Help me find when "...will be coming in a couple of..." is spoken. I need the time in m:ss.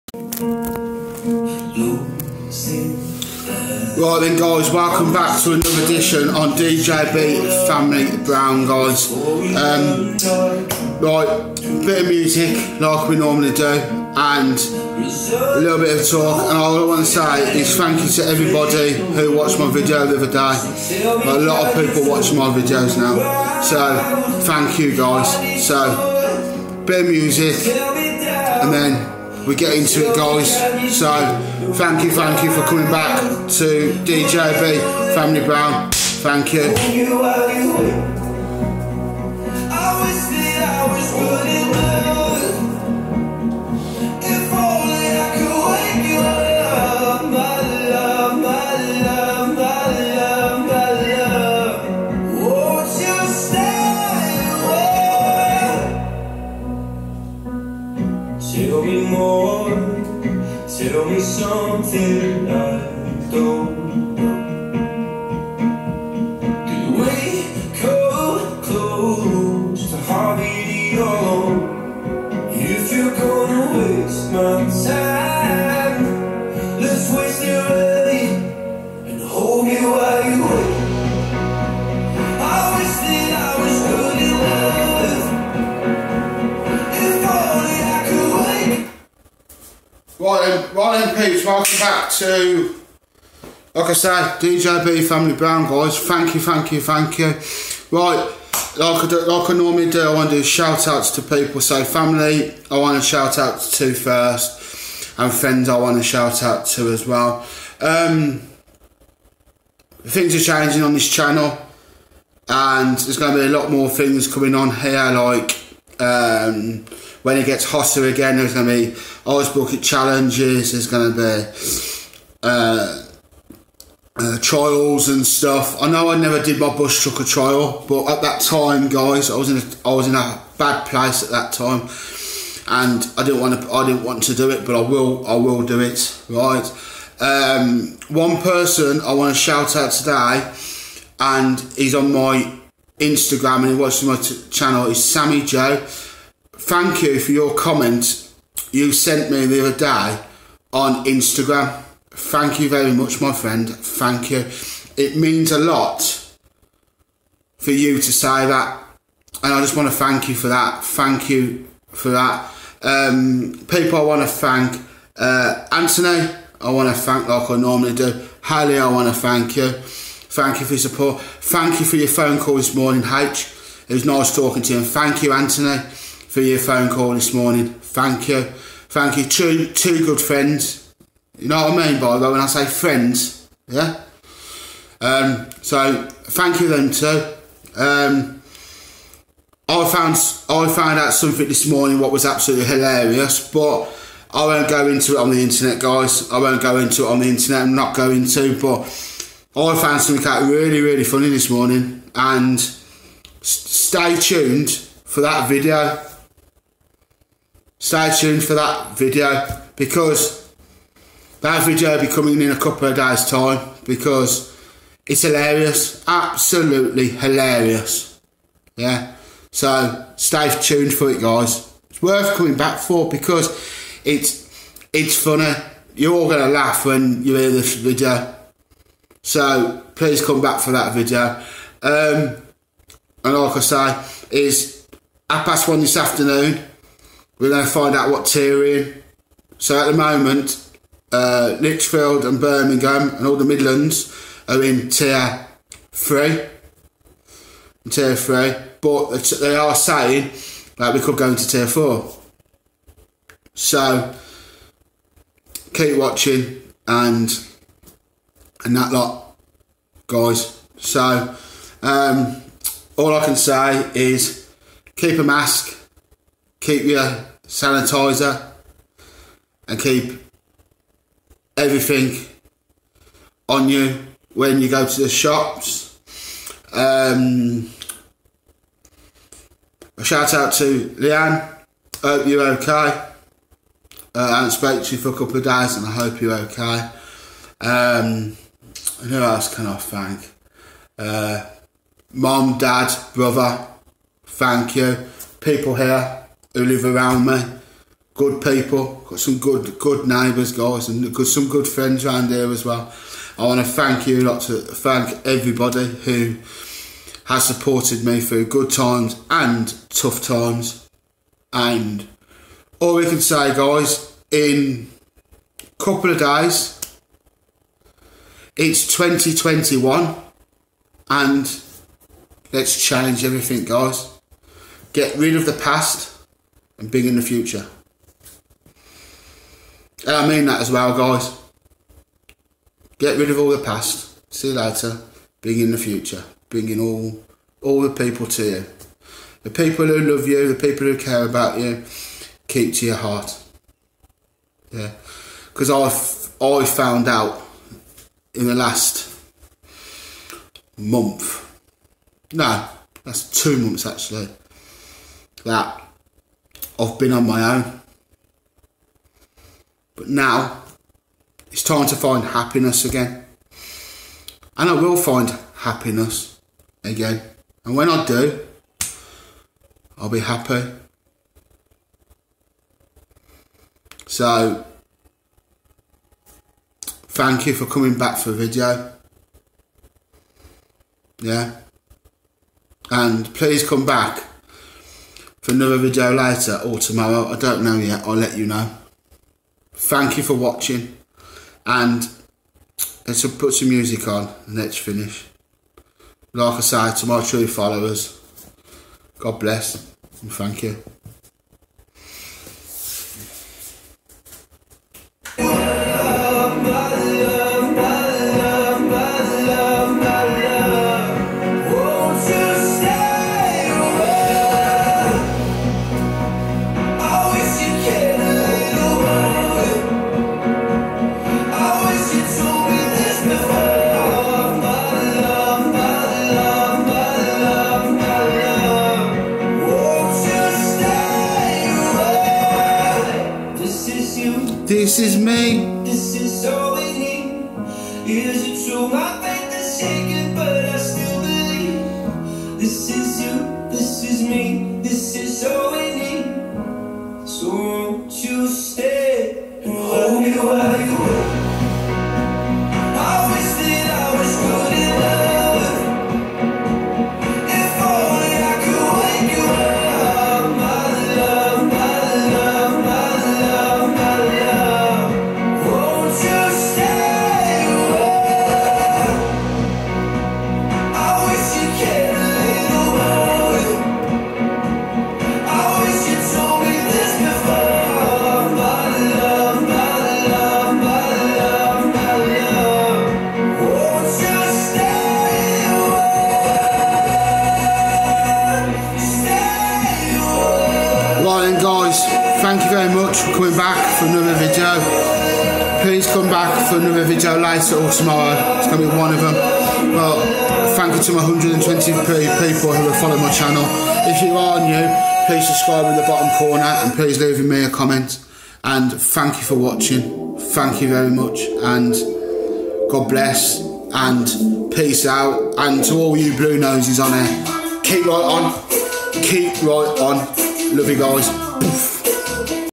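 3:31.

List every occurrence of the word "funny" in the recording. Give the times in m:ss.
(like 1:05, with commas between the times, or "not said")
3:21, 3:45.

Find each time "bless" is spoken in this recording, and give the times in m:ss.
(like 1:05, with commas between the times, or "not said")
6:39, 8:33.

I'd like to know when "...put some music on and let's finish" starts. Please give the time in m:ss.
6:33.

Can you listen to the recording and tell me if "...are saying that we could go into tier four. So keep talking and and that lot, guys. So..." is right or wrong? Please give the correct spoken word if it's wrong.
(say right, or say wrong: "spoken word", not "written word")
wrong: "watching", not "talking".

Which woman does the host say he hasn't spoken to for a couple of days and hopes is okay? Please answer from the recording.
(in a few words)
Leanne.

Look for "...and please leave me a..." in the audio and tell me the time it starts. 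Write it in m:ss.
8:26.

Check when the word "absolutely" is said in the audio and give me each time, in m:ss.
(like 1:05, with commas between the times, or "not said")
3:12, 3:36.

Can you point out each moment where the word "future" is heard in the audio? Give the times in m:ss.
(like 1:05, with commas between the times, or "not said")
5:27, 5:35.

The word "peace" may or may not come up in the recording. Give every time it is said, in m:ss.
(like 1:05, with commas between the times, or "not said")
8:34.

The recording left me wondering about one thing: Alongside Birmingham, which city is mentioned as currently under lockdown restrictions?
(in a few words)
Lichfield.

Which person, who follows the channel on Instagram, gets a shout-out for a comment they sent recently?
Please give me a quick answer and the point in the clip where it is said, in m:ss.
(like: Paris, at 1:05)
Sammy Joe, at 2:25.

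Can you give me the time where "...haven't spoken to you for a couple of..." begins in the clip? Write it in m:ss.
4:44.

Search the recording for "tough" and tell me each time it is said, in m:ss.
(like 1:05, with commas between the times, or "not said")
5:09.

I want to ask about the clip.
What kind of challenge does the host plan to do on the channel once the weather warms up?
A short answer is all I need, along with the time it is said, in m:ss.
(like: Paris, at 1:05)
Ice Bucket Challenges, at 1:59.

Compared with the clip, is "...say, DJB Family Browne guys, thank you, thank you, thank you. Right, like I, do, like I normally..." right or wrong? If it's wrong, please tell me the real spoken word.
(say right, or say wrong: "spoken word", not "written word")
right.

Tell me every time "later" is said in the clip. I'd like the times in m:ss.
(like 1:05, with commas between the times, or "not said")
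5:34, 6:26, 8:17.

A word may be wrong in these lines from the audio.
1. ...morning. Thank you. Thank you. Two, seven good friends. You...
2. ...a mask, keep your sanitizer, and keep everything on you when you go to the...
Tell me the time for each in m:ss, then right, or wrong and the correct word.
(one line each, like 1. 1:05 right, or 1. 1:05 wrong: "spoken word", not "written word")
1. 2:57 wrong: "two", not "seven"
2. 4:25 right.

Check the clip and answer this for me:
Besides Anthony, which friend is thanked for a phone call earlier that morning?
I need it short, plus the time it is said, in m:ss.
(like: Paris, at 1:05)
Haley, at 2:48.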